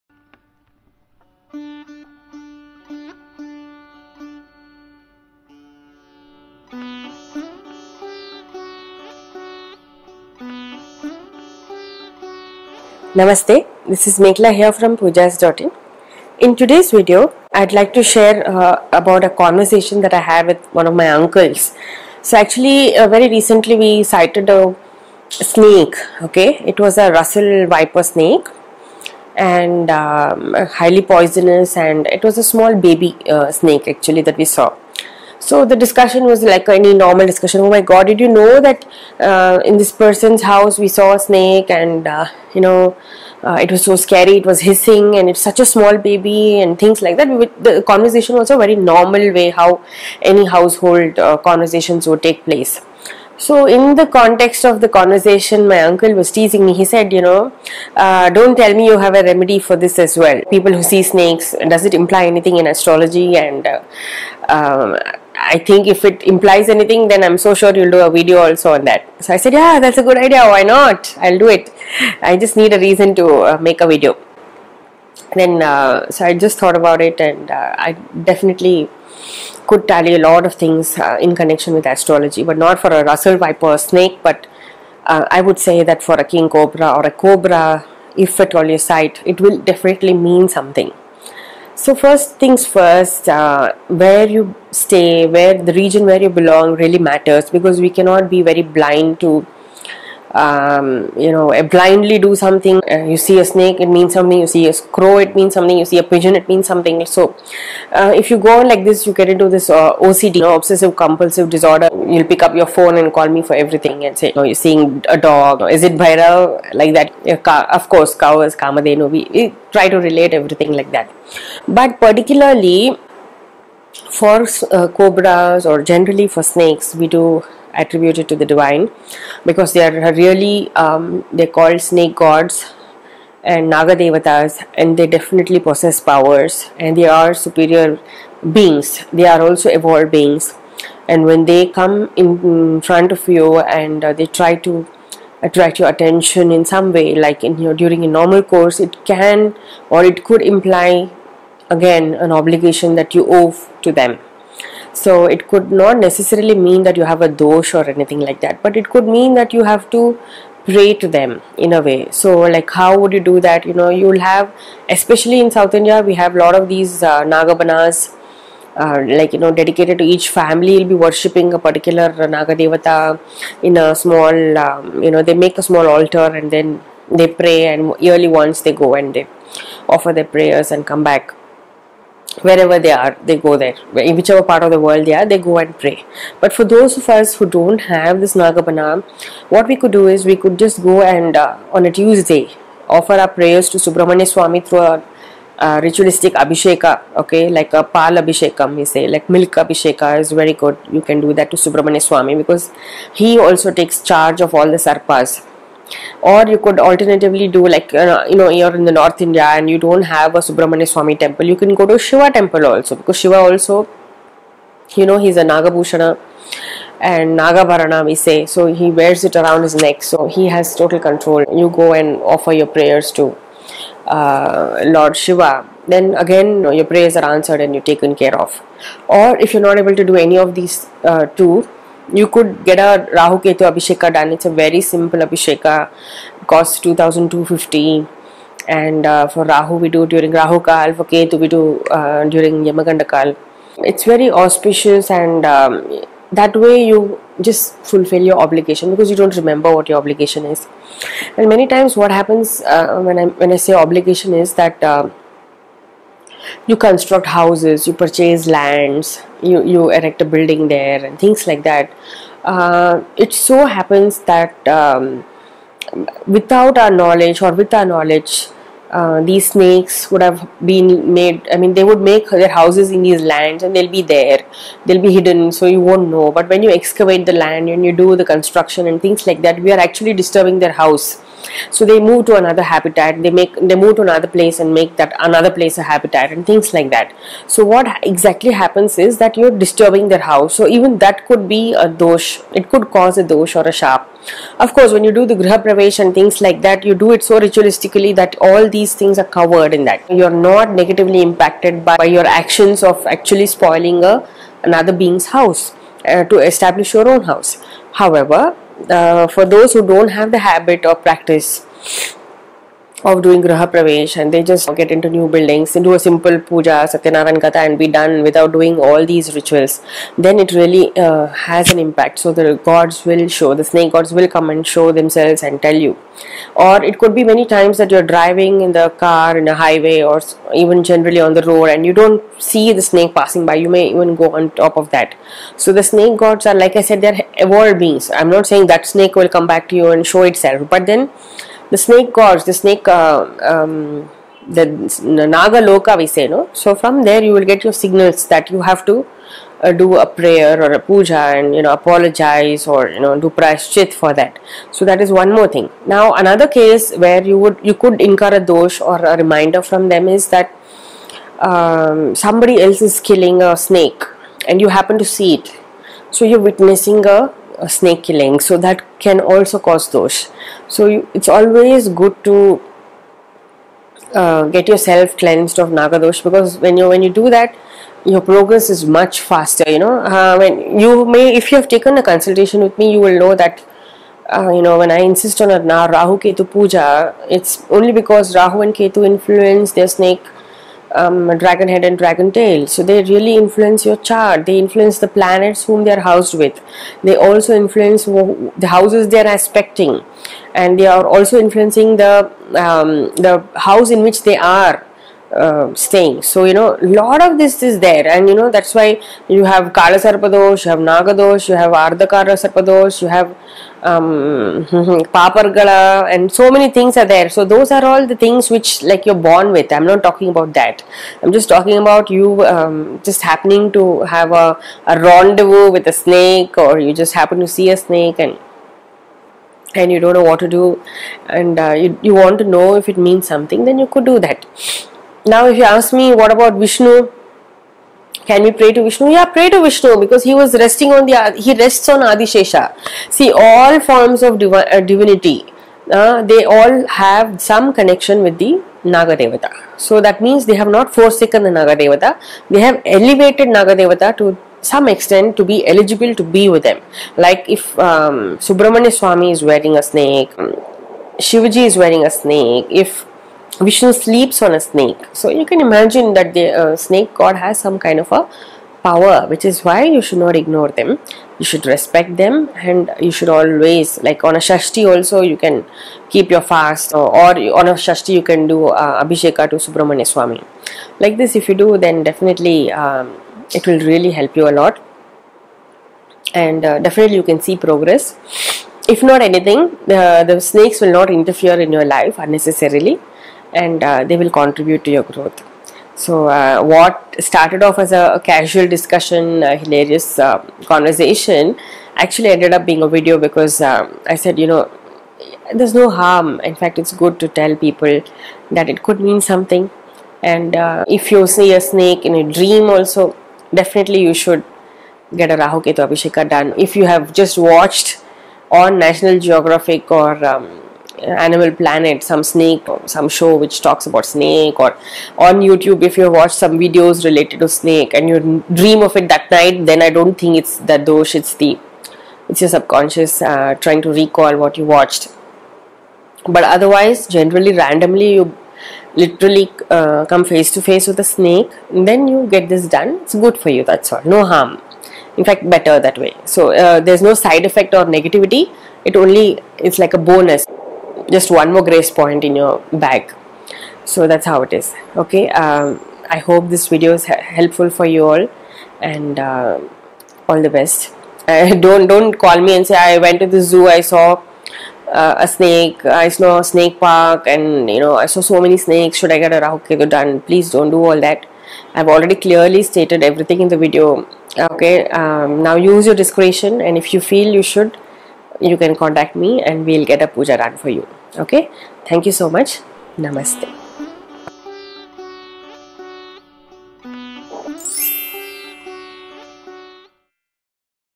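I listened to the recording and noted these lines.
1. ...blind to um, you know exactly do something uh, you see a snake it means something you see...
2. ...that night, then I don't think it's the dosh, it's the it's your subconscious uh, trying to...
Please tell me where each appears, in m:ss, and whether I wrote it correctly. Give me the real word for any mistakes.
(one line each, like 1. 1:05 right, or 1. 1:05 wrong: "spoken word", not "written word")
1. 1:38 wrong: "blindly", not "exactly"
2. 8:49 right.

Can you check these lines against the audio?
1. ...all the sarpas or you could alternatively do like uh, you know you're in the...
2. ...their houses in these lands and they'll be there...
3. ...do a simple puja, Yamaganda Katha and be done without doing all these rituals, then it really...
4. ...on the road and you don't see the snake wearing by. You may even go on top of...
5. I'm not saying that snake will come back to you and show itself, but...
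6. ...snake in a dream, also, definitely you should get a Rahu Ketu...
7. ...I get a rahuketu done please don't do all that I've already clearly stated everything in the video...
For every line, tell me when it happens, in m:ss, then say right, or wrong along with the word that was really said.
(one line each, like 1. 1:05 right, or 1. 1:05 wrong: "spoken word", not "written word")
1. 3:24 right
2. 4:32 right
3. 5:15 wrong: "Satyanaran", not "Yamaganda"
4. 5:31 wrong: "passing", not "wearing"
5. 5:38 right
6. 8:31 right
7. 9:29 right.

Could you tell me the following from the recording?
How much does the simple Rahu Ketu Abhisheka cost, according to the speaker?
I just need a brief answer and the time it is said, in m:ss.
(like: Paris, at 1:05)
2250, at 3:56.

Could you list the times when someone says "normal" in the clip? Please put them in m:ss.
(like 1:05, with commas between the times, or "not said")
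0:36, 0:48, 2:28.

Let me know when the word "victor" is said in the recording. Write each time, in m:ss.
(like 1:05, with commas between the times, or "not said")
not said.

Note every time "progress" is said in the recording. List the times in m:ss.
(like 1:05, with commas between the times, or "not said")
6:18, 8:07.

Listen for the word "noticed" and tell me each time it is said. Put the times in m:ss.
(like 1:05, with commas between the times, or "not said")
not said.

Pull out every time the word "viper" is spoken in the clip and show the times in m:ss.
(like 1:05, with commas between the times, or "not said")
0:27, 1:23.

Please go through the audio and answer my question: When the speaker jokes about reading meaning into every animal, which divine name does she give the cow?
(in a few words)
Kamadenu.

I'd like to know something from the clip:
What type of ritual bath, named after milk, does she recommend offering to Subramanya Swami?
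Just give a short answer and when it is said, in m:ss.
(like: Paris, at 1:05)
pal abhishekam, at 3:17.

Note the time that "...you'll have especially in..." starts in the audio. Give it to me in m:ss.
2:43.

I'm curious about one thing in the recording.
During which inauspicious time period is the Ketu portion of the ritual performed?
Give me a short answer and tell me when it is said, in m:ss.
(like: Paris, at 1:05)
Yamaganda Kal, at 4:02.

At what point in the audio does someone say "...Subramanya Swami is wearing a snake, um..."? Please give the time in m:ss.
7:38.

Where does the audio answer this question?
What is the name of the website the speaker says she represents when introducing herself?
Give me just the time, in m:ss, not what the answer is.
0:14.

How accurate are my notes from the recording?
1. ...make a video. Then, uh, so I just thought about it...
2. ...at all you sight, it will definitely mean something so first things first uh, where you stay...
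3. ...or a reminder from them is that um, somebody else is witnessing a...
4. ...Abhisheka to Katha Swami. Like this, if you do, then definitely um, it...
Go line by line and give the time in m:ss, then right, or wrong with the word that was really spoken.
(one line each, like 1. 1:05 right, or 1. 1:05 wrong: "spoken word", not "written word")
1. 1:13 right
2. 1:28 right
3. 5:58 wrong: "killing", not "witnessing"
4. 7:59 wrong: "Subramanya", not "Katha".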